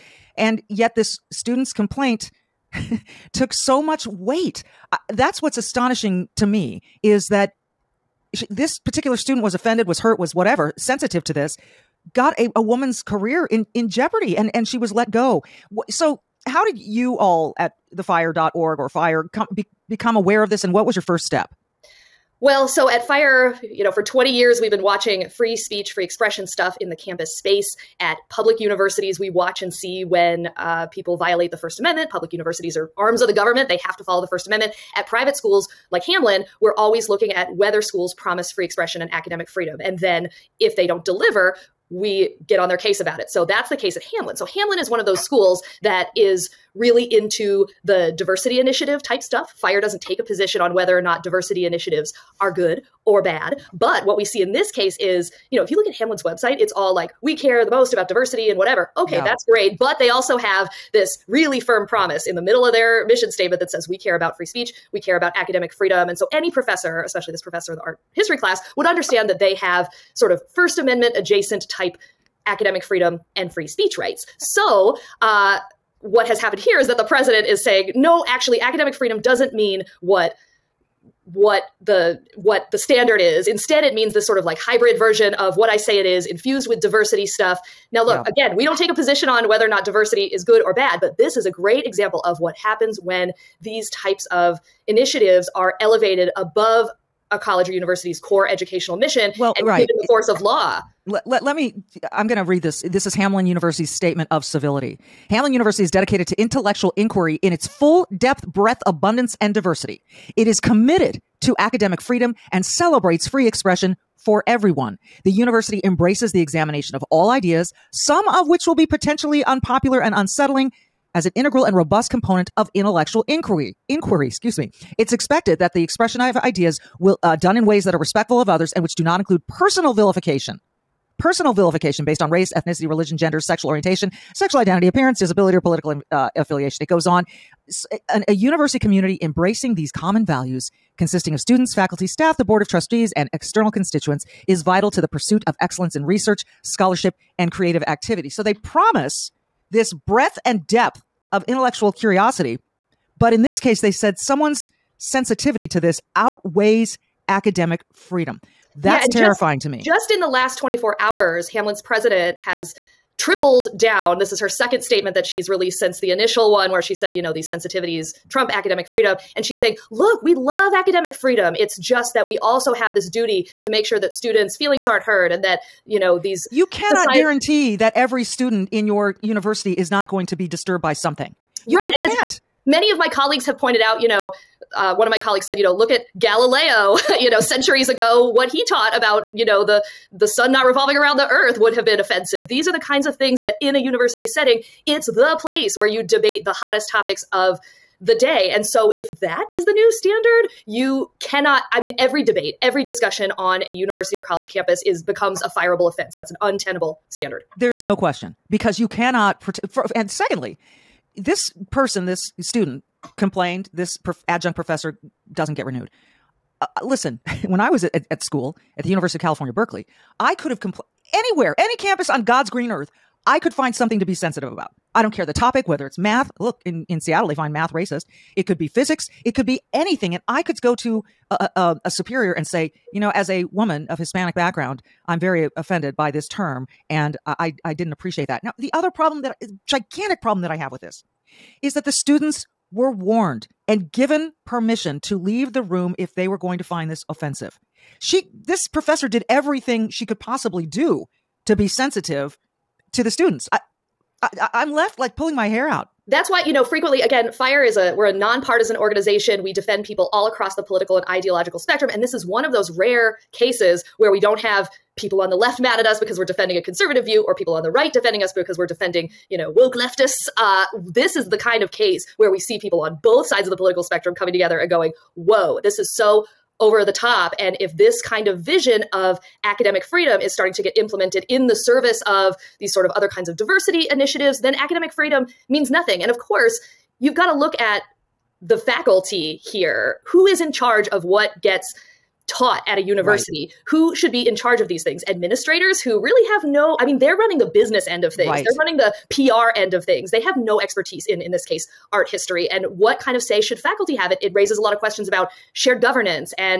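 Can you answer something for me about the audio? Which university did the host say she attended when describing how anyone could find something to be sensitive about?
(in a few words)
University of California, Berkeley.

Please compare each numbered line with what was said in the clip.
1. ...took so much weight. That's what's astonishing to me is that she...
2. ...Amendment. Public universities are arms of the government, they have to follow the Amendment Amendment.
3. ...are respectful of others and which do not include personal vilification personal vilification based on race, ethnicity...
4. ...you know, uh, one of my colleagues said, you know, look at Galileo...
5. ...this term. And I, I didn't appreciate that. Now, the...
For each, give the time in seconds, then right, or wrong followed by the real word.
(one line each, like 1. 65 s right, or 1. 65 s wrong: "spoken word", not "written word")
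1. 3 s right
2. 31 s wrong: "First", not "Amendment"
3. 127 s right
4. 184 s right
5. 236 s right.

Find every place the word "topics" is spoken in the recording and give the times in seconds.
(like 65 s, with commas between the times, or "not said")
196 s, 225 s.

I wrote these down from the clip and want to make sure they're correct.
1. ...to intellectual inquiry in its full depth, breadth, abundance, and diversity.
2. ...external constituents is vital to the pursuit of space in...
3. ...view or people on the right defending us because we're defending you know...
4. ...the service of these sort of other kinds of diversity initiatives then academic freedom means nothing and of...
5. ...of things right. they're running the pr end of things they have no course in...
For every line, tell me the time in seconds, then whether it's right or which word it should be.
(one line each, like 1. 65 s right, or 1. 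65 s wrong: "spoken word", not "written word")
1. 106 s right
2. 143 s wrong: "excellence", not "space"
3. 267 s right
4. 281 s right
5. 298 s wrong: "expertise", not "course".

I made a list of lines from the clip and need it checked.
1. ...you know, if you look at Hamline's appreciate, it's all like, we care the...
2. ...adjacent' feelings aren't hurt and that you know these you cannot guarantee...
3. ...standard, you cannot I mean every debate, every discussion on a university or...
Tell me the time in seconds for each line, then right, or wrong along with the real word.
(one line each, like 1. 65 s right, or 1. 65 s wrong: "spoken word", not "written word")
1. 55 s wrong: "website", not "appreciate"
2. 174 s wrong: "students", not "adjacent"
3. 199 s right.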